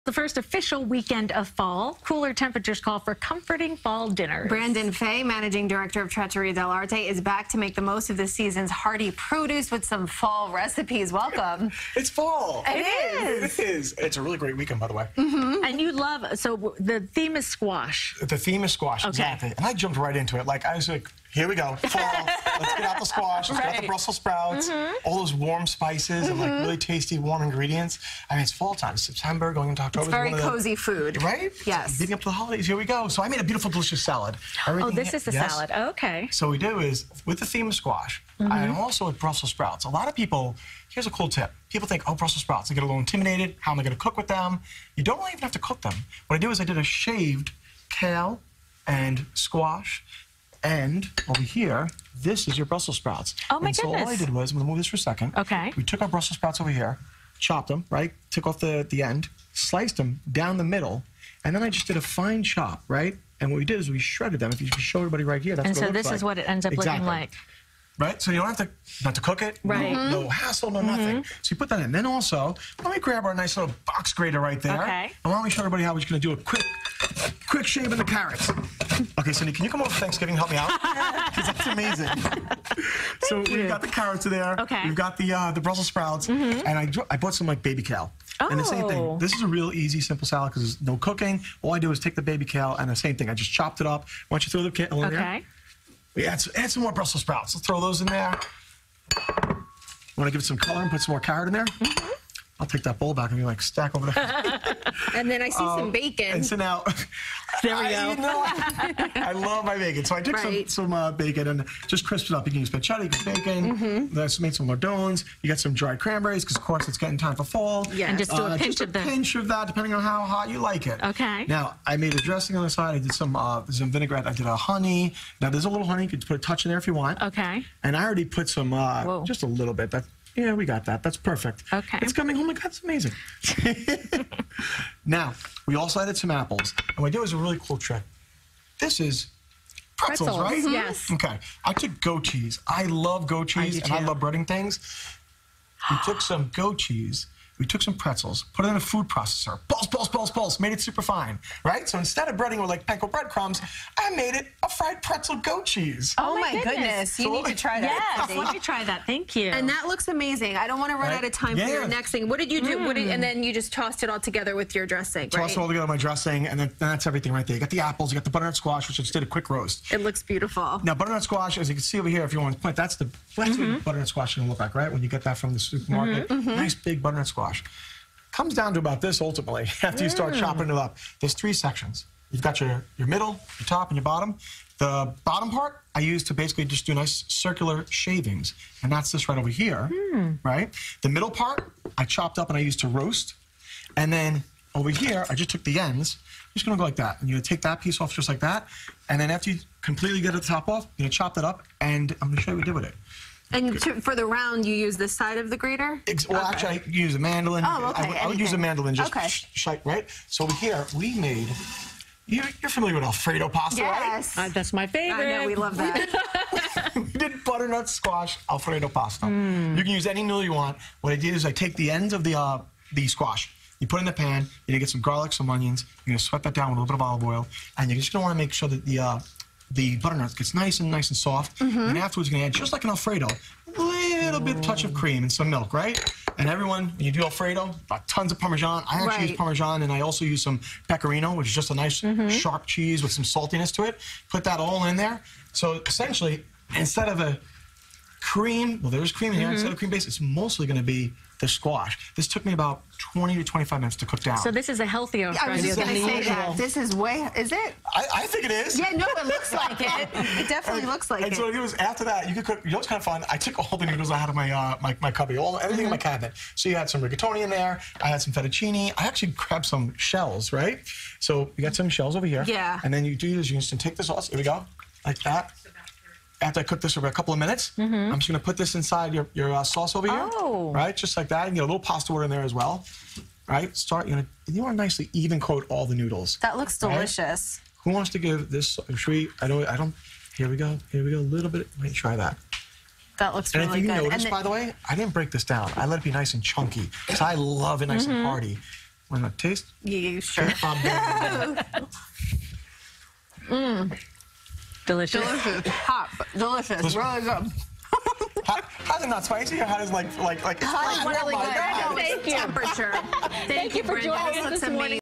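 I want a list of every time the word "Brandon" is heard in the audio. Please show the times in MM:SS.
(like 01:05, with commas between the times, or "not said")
00:04.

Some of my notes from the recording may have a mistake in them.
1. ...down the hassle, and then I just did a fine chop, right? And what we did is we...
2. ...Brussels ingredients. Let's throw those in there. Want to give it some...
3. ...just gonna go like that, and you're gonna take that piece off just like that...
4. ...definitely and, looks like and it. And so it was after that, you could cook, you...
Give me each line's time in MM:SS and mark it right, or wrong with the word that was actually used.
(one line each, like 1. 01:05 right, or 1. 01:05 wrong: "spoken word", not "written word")
1. 01:00 wrong: "middle", not "hassle"
2. 01:36 wrong: "sprouts", not "ingredients"
3. 03:16 right
4. 04:20 right.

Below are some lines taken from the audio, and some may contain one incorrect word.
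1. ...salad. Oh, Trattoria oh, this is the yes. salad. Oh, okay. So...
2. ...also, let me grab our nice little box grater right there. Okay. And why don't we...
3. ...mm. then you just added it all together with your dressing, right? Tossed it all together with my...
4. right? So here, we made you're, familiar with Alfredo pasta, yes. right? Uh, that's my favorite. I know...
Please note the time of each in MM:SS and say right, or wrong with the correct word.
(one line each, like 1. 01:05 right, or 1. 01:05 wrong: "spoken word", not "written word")
1. 00:34 wrong: "Everything", not "Trattoria"
2. 01:12 right
3. 02:43 wrong: "tossed", not "added"
4. 03:29 right.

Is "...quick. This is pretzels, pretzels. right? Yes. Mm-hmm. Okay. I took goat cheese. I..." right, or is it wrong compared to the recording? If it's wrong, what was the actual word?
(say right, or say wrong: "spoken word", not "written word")
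wrong: "trick", not "quick".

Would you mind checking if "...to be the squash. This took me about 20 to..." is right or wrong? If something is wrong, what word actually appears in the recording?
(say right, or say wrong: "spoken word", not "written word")
right.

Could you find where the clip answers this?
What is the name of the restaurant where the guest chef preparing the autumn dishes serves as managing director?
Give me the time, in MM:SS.
00:06.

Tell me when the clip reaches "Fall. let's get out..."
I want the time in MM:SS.
00:21.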